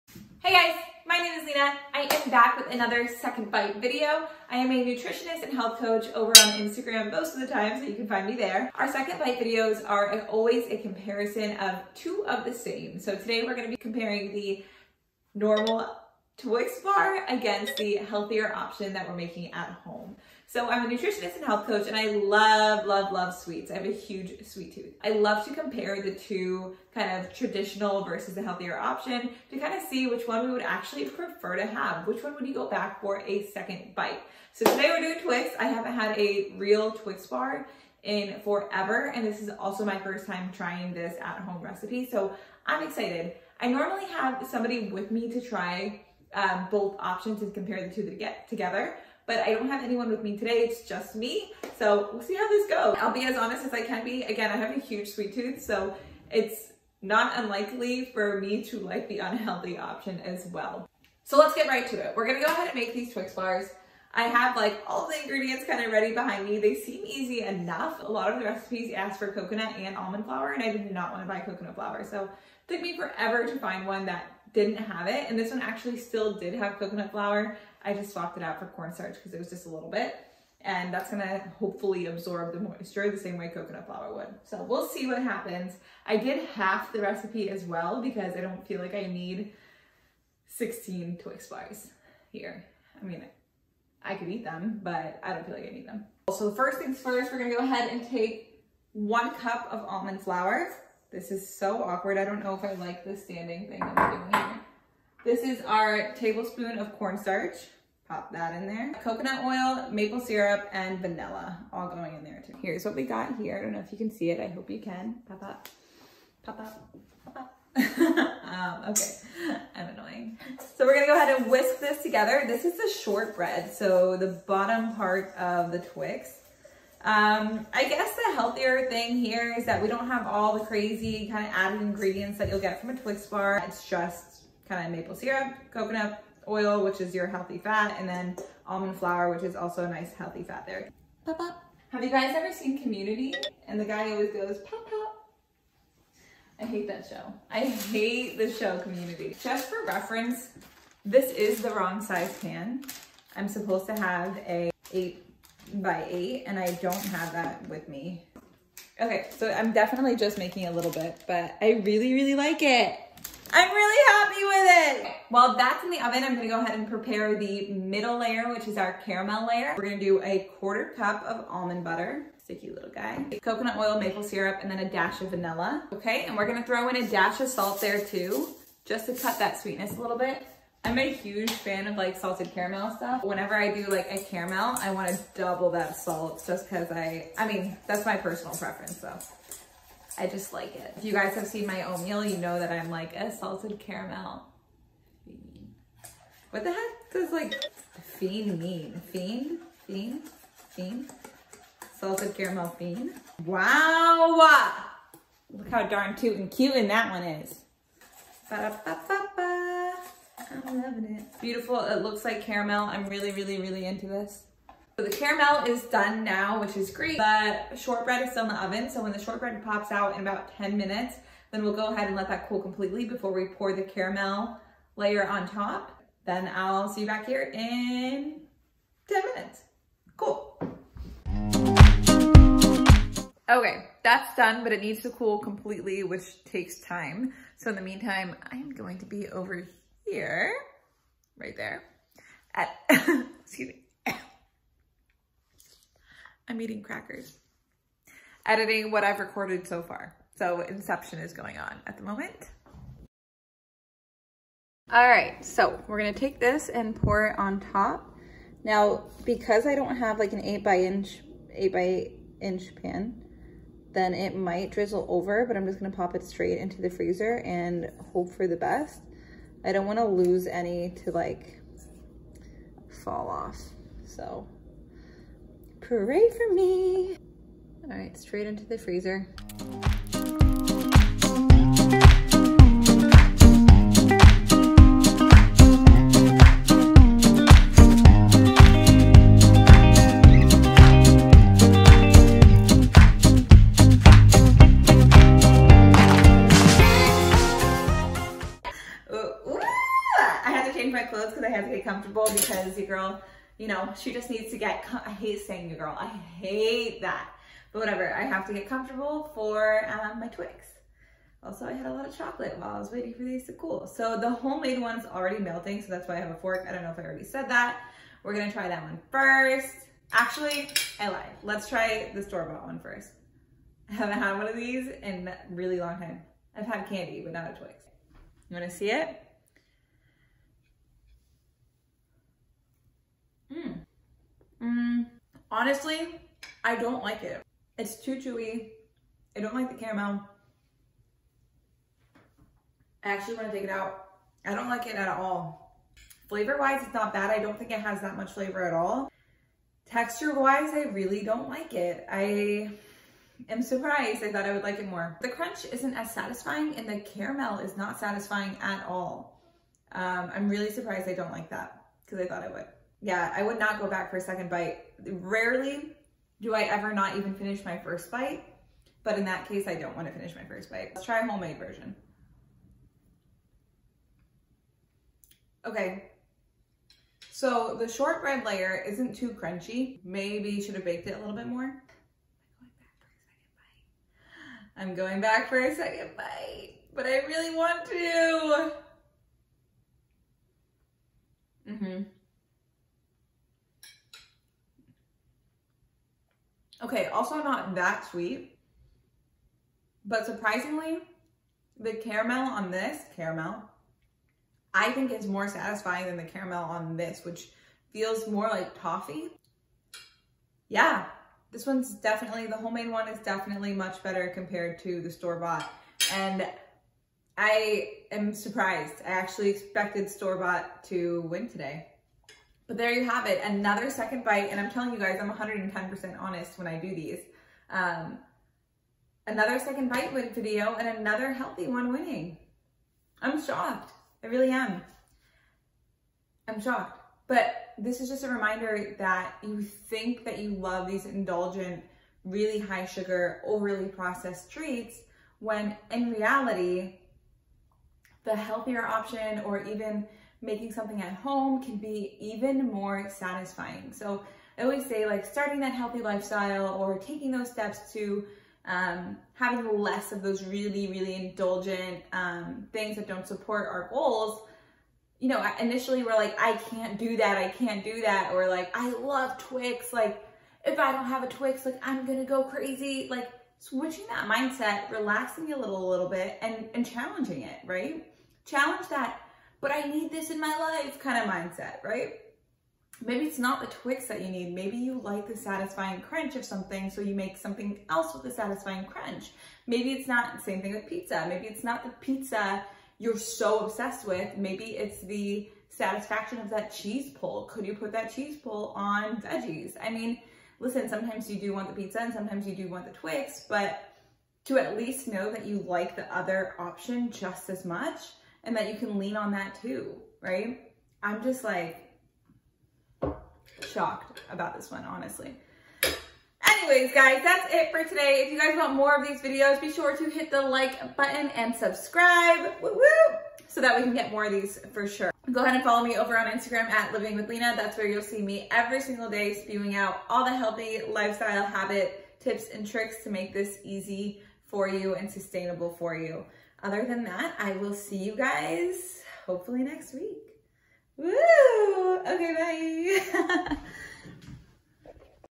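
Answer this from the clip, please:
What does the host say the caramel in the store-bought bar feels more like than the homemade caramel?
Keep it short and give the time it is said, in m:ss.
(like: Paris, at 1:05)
toffee, at 6:48.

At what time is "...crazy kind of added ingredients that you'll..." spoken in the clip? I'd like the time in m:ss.
2:10.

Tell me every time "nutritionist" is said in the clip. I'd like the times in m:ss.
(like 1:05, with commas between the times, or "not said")
0:04, 0:20.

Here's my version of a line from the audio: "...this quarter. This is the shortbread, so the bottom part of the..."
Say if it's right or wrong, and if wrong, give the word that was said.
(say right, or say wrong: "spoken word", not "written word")
wrong: "together", not "quarter".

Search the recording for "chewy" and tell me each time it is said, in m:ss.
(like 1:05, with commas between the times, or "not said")
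5:38.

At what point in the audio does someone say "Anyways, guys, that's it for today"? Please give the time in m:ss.
8:36.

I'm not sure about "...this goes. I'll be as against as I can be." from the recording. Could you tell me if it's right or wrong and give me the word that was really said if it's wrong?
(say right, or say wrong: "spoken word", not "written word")
wrong: "honest", not "against".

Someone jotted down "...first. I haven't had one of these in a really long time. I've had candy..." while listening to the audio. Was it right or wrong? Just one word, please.
right.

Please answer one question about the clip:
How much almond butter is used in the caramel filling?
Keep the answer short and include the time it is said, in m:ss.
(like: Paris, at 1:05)
a quarter cup, at 2:50.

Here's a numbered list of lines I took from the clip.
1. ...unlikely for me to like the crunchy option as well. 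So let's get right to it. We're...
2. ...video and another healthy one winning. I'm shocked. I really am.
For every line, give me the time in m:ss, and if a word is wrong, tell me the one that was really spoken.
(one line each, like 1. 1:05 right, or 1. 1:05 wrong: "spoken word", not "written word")
1. 0:57 wrong: "unhealthy", not "crunchy"
2. 7:10 right.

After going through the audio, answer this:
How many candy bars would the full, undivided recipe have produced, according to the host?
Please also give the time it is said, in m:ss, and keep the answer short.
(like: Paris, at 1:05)
16, at 1:30.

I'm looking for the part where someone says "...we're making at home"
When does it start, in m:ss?
0:19.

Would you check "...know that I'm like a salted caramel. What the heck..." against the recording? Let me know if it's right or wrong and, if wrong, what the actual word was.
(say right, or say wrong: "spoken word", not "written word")
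right.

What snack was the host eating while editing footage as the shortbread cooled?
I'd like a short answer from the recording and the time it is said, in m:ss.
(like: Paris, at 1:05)
crackers, at 4:06.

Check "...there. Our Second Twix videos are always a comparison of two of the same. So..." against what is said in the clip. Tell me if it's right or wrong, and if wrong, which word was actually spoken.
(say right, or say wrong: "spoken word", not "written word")
wrong: "Bite", not "Twix".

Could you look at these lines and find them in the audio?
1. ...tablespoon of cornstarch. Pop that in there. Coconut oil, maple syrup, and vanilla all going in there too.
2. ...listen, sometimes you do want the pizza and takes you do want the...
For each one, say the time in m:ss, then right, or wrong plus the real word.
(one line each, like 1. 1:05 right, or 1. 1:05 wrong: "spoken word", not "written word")
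1. 1:46 right
2. 8:20 wrong: "sometimes", not "takes".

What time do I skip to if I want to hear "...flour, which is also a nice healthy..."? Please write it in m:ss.
2:18.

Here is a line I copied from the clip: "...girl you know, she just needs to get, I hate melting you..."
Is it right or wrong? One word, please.
wrong.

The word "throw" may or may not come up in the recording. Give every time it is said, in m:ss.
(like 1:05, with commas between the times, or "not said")
2:56.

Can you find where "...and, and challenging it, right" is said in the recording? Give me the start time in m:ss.
7:56.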